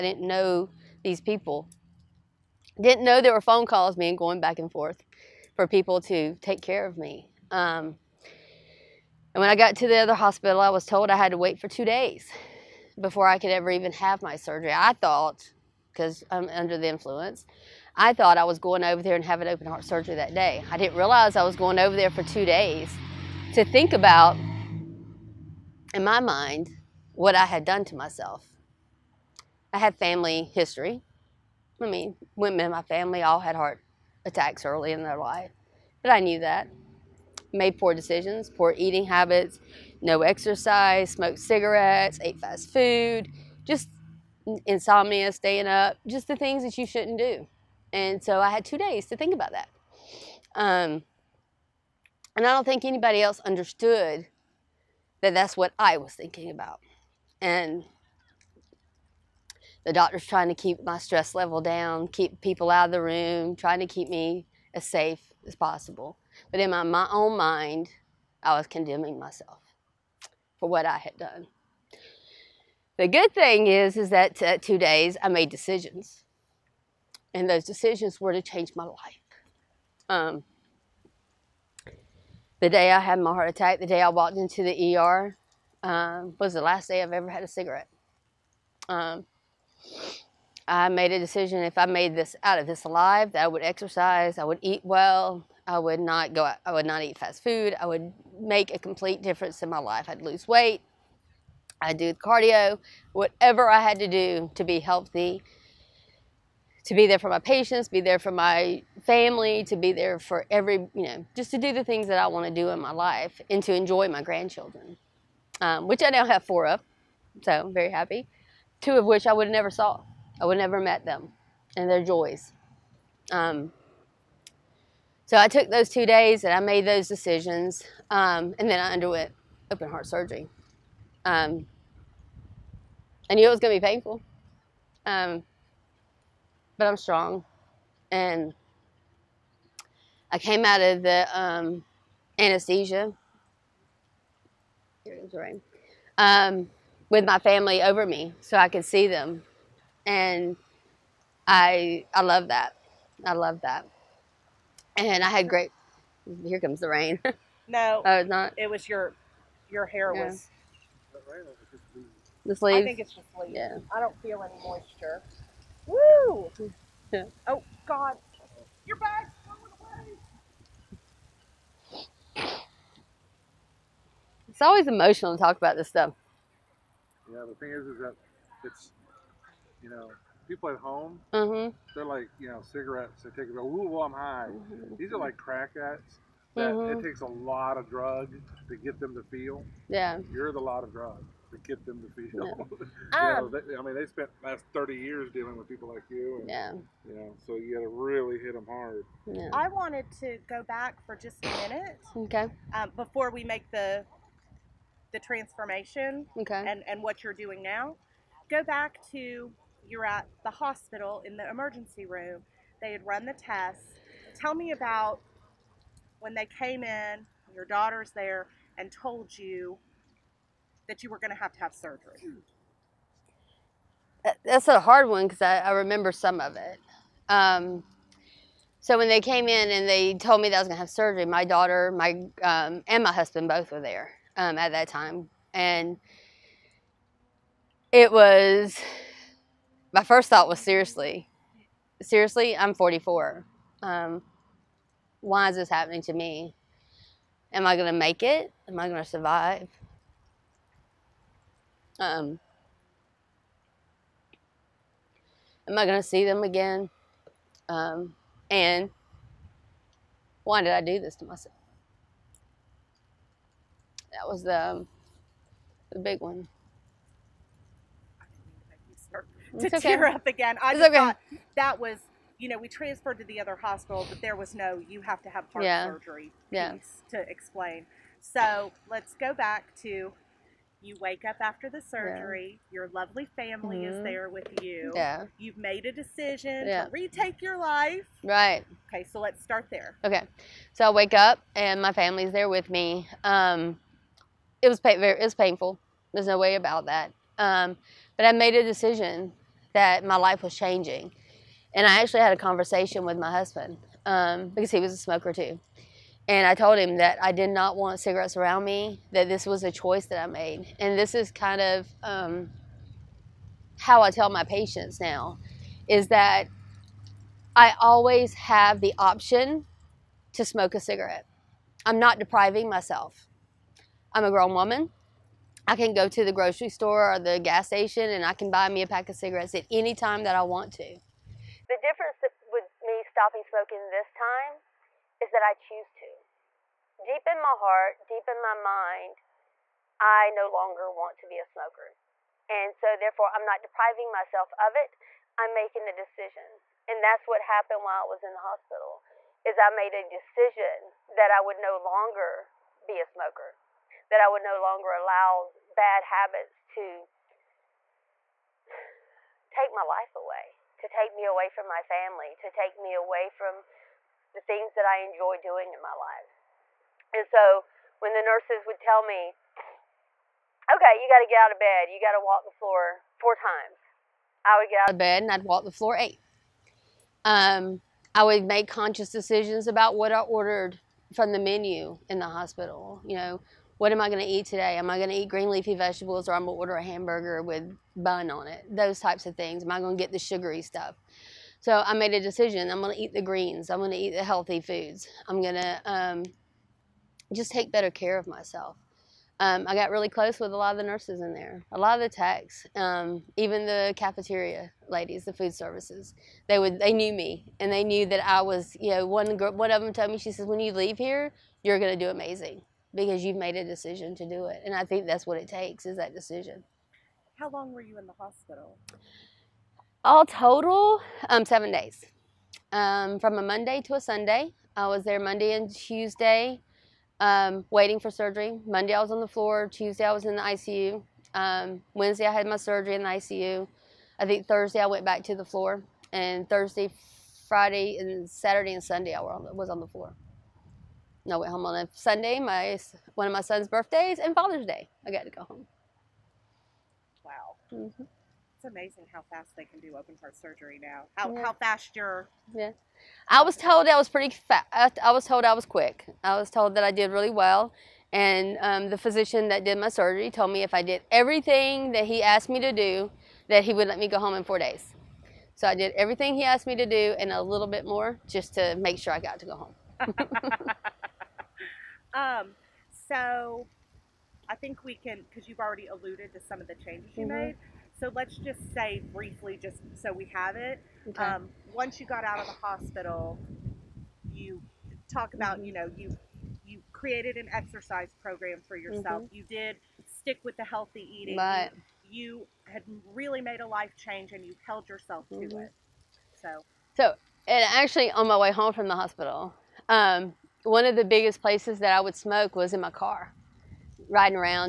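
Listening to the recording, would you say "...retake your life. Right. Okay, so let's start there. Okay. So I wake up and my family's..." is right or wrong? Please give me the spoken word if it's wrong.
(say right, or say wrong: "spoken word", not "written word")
right.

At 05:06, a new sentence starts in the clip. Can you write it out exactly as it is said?
And I told him that I did not want cigarettes around me, that this was a choice that I made.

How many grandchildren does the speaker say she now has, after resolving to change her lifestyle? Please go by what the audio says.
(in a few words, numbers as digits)
4.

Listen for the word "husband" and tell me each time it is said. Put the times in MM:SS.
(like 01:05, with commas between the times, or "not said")
03:53, 05:03.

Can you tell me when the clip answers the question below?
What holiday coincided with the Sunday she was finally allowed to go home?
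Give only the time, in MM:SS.
07:24.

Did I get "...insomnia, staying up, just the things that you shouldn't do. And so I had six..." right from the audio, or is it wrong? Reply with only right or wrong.
wrong.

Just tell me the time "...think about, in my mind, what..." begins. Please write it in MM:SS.
00:23.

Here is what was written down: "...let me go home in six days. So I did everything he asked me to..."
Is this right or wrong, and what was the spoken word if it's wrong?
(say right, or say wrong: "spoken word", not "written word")
wrong: "four", not "six".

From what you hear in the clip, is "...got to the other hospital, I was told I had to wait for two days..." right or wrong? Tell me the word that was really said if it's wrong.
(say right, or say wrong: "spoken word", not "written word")
right.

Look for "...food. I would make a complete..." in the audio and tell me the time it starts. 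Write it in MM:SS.
01:37.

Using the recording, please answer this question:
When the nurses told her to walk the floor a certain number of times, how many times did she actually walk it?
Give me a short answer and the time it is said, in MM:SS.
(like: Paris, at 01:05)
8, at 06:15.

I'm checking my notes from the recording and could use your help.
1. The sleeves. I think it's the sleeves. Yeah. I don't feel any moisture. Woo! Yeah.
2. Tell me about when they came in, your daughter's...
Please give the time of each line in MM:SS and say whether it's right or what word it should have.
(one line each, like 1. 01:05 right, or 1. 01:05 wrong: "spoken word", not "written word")
1. 02:42 right
2. 03:34 right.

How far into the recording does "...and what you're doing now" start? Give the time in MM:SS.
03:26.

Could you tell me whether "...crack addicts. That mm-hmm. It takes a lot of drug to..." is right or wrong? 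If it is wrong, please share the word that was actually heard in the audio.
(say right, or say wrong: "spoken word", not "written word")
right.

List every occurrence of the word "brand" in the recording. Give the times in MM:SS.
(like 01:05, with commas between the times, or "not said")
not said.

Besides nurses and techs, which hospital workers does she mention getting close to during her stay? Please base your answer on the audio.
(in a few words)
cafeteria ladies.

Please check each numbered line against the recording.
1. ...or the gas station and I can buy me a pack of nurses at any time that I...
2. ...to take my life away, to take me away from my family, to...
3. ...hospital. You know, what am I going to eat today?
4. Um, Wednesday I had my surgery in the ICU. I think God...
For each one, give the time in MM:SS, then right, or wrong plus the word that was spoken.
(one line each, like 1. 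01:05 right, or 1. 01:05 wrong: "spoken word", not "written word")
1. 05:27 wrong: "cigarettes", not "nurses"
2. 05:56 right
3. 06:22 right
4. 07:11 wrong: "Thursday", not "God".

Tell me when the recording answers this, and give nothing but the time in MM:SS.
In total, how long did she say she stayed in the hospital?
07:01.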